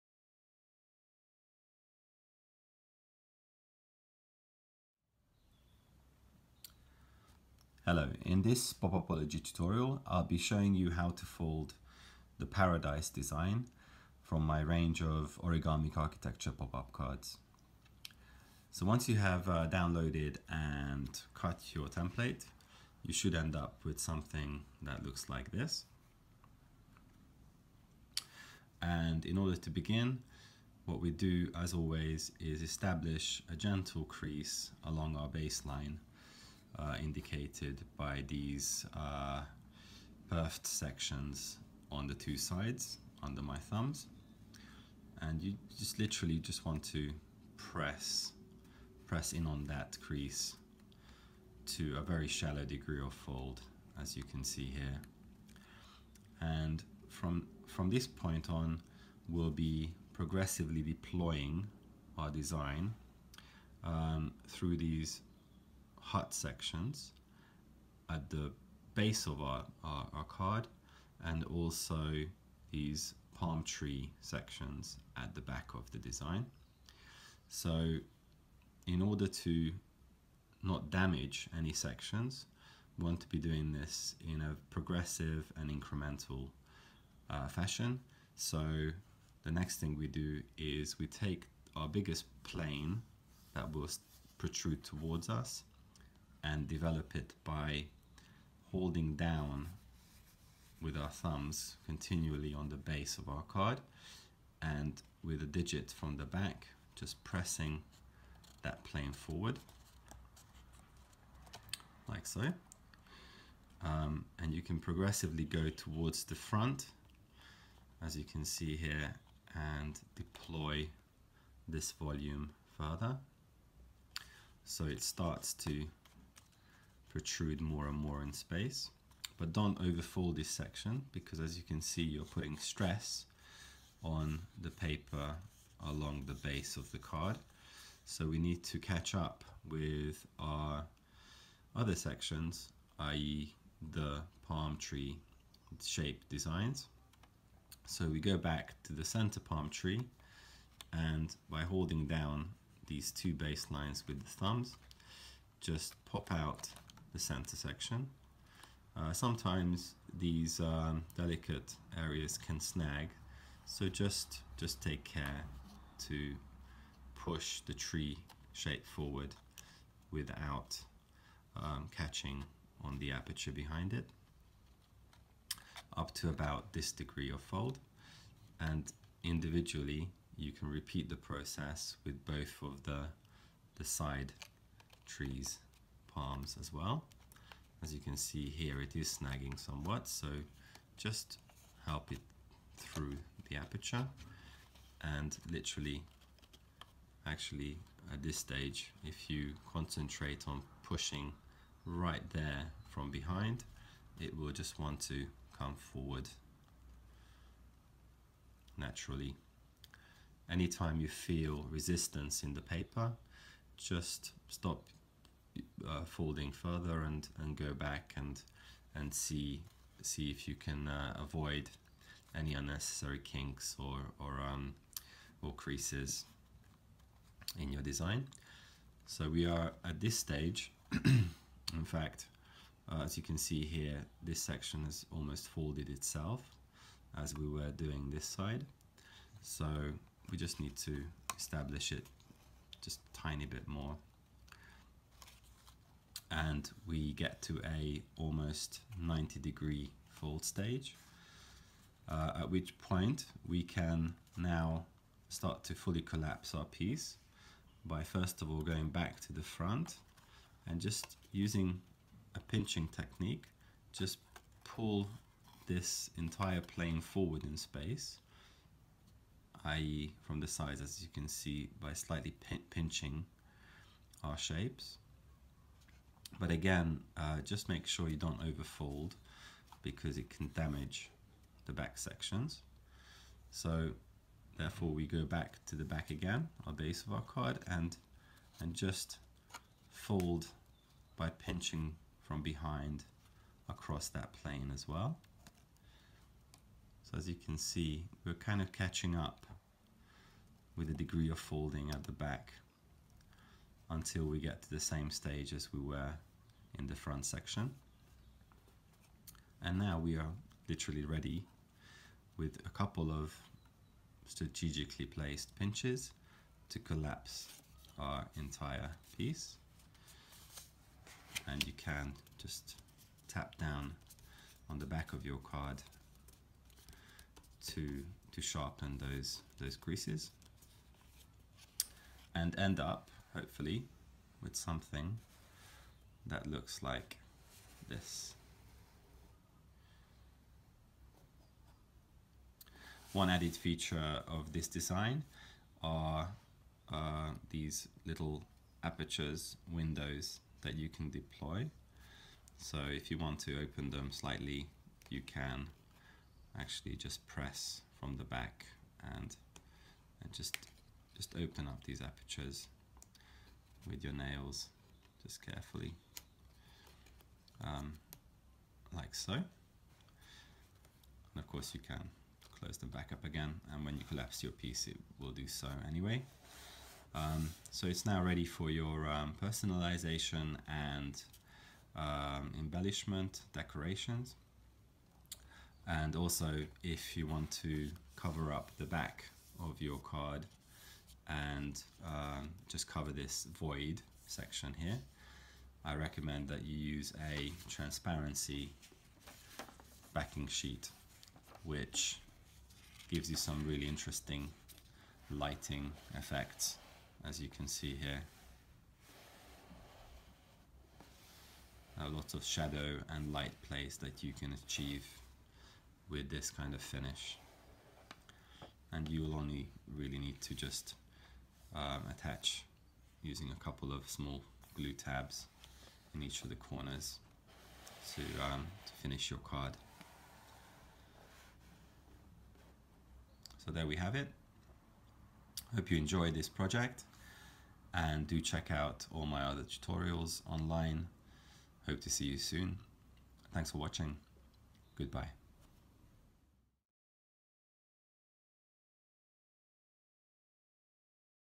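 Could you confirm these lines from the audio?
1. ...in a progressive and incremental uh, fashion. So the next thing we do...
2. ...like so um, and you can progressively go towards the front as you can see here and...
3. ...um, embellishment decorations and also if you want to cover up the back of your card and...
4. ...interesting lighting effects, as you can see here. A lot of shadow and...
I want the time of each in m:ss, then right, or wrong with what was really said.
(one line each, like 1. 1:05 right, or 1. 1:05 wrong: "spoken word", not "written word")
1. 1:24 right
2. 1:52 right
3. 6:21 right
4. 6:43 right.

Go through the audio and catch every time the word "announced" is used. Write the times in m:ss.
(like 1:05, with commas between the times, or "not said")
not said.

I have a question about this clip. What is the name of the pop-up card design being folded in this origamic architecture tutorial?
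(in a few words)
Paradise.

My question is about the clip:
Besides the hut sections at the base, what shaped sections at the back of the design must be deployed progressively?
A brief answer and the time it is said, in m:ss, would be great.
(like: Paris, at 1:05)
palm tree sections, at 1:13.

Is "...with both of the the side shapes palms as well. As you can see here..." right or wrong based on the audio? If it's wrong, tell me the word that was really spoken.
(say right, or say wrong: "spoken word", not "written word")
wrong: "trees", not "shapes".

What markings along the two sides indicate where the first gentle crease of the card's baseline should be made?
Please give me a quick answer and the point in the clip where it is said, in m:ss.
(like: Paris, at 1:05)
perfed sections, at 0:40.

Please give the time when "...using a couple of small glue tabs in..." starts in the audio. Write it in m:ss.
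7:03.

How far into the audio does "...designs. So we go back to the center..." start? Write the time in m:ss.
2:26.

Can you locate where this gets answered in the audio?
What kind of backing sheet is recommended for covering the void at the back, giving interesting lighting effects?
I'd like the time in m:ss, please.
6:37.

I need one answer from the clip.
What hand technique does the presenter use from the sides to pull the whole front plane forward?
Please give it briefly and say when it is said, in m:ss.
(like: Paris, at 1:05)
pinching technique, at 4:22.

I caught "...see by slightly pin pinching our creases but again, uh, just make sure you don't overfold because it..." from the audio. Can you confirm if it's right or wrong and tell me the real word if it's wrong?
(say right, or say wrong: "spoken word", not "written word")
wrong: "shapes", not "creases".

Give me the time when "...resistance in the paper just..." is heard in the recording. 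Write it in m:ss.
3:31.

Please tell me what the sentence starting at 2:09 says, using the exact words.
But don't overfold this section because as you can see you're putting stress on the paper along the base of the card.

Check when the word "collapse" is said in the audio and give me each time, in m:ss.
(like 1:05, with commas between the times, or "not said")
4:16, 5:16, 6:14.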